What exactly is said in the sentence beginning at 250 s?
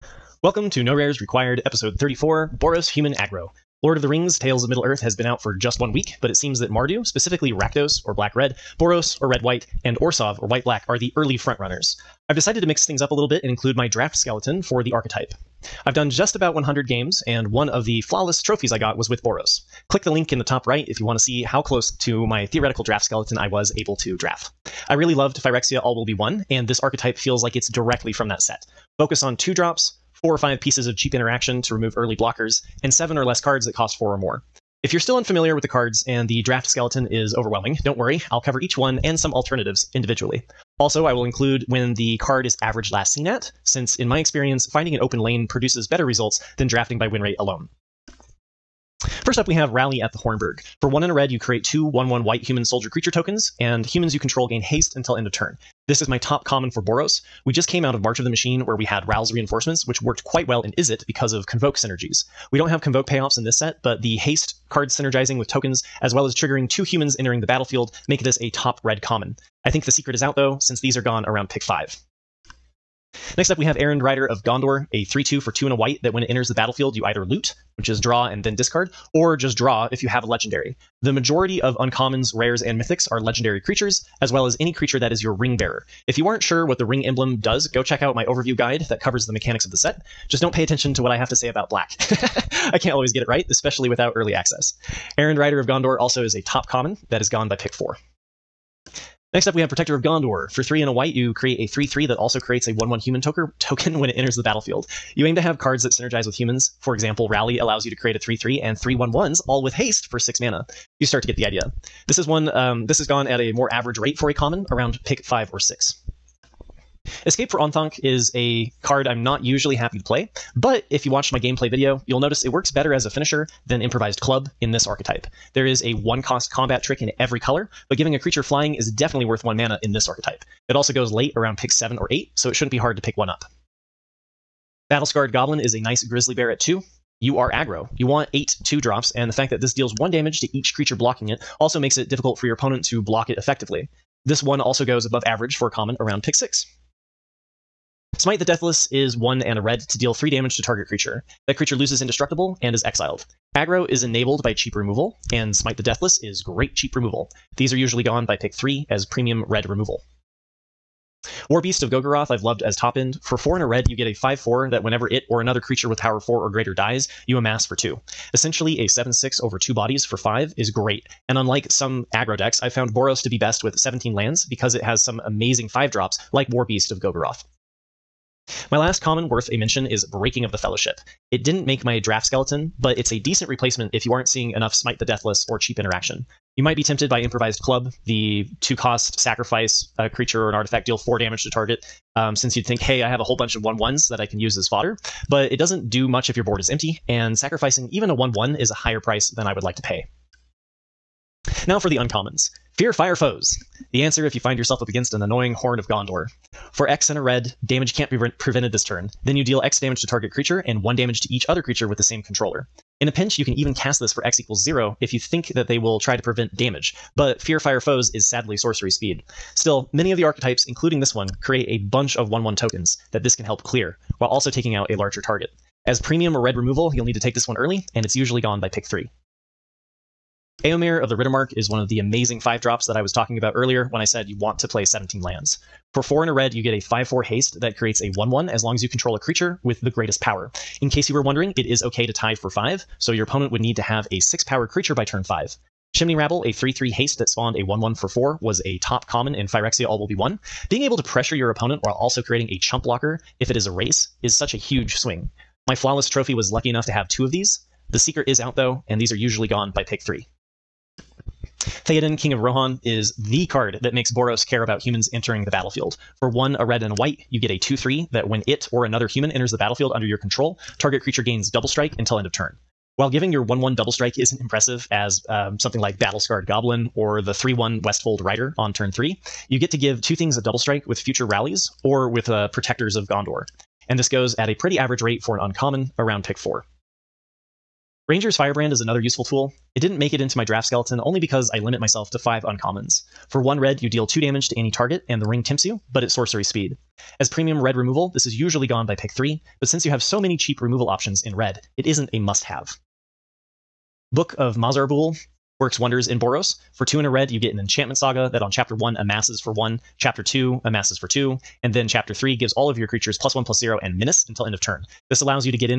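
Being able to pressure your opponent while also creating a chump blocker if it is a race is such a huge swing.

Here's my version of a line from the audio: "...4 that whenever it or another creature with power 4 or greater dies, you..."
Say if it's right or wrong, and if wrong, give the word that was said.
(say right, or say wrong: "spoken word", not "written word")
right.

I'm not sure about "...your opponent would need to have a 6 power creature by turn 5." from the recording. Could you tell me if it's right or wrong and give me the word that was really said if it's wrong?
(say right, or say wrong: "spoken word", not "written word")
right.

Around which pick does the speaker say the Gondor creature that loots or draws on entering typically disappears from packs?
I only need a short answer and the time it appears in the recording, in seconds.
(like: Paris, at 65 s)
pick 4, at 97 s.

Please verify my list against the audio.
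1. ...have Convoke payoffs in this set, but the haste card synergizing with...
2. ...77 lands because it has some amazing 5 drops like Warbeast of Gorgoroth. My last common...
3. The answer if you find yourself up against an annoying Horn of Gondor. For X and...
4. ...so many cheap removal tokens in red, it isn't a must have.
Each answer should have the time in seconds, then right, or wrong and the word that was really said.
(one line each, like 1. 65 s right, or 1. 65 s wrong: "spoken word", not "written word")
1. 62 s right
2. 173 s wrong: "17", not "77"
3. 203 s right
4. 300 s wrong: "options", not "tokens".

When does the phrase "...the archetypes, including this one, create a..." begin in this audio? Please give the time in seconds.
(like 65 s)
220 s.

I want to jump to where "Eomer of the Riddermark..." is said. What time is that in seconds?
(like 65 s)
230 s.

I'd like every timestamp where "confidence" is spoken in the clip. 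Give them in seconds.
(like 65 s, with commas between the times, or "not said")
not said.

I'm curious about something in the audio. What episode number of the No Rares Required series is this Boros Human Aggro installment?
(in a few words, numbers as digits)
34.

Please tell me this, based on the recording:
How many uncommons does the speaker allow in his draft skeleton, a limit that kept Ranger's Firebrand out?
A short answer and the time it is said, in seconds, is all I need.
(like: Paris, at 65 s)
5, at 292 s.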